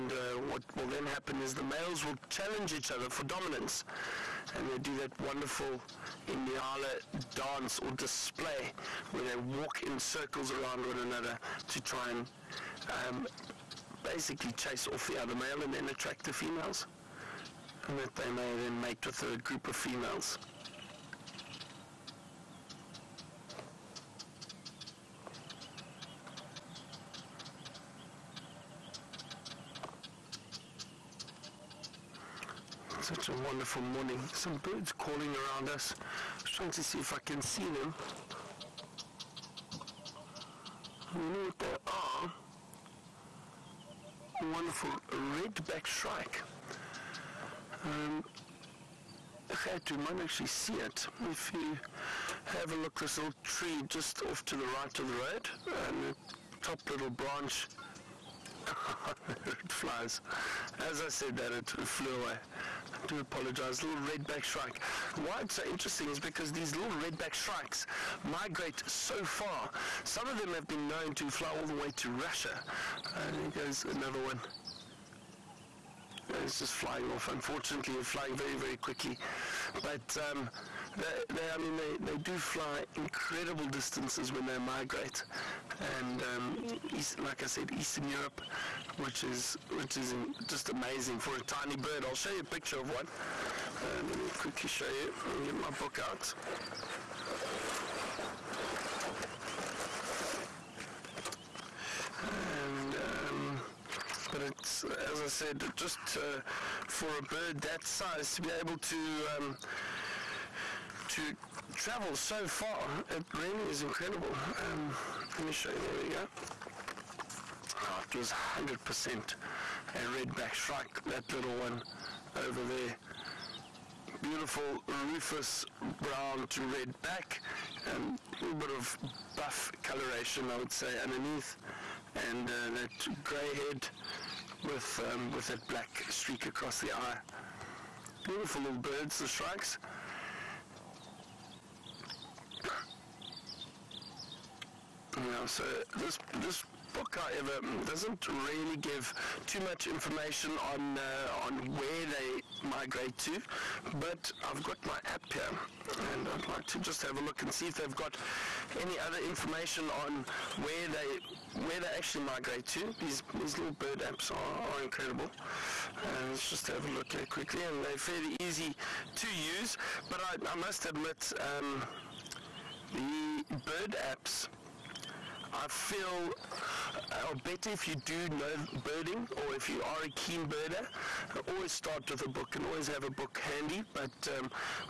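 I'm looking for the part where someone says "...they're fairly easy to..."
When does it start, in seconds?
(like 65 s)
167 s.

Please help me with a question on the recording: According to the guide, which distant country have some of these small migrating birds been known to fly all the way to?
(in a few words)
Russia.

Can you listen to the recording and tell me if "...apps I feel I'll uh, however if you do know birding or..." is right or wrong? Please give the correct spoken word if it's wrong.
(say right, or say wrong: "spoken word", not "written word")
wrong: "better", not "however".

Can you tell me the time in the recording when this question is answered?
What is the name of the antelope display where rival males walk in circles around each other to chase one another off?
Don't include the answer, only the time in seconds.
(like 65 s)
6 s.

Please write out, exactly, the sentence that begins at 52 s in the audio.
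This little tree just off to the right of the road, and the top little branch.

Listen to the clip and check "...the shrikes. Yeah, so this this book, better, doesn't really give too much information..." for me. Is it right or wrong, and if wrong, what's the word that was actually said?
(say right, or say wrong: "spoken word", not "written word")
wrong: "however", not "better".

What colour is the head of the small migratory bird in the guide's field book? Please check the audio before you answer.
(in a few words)
Grey.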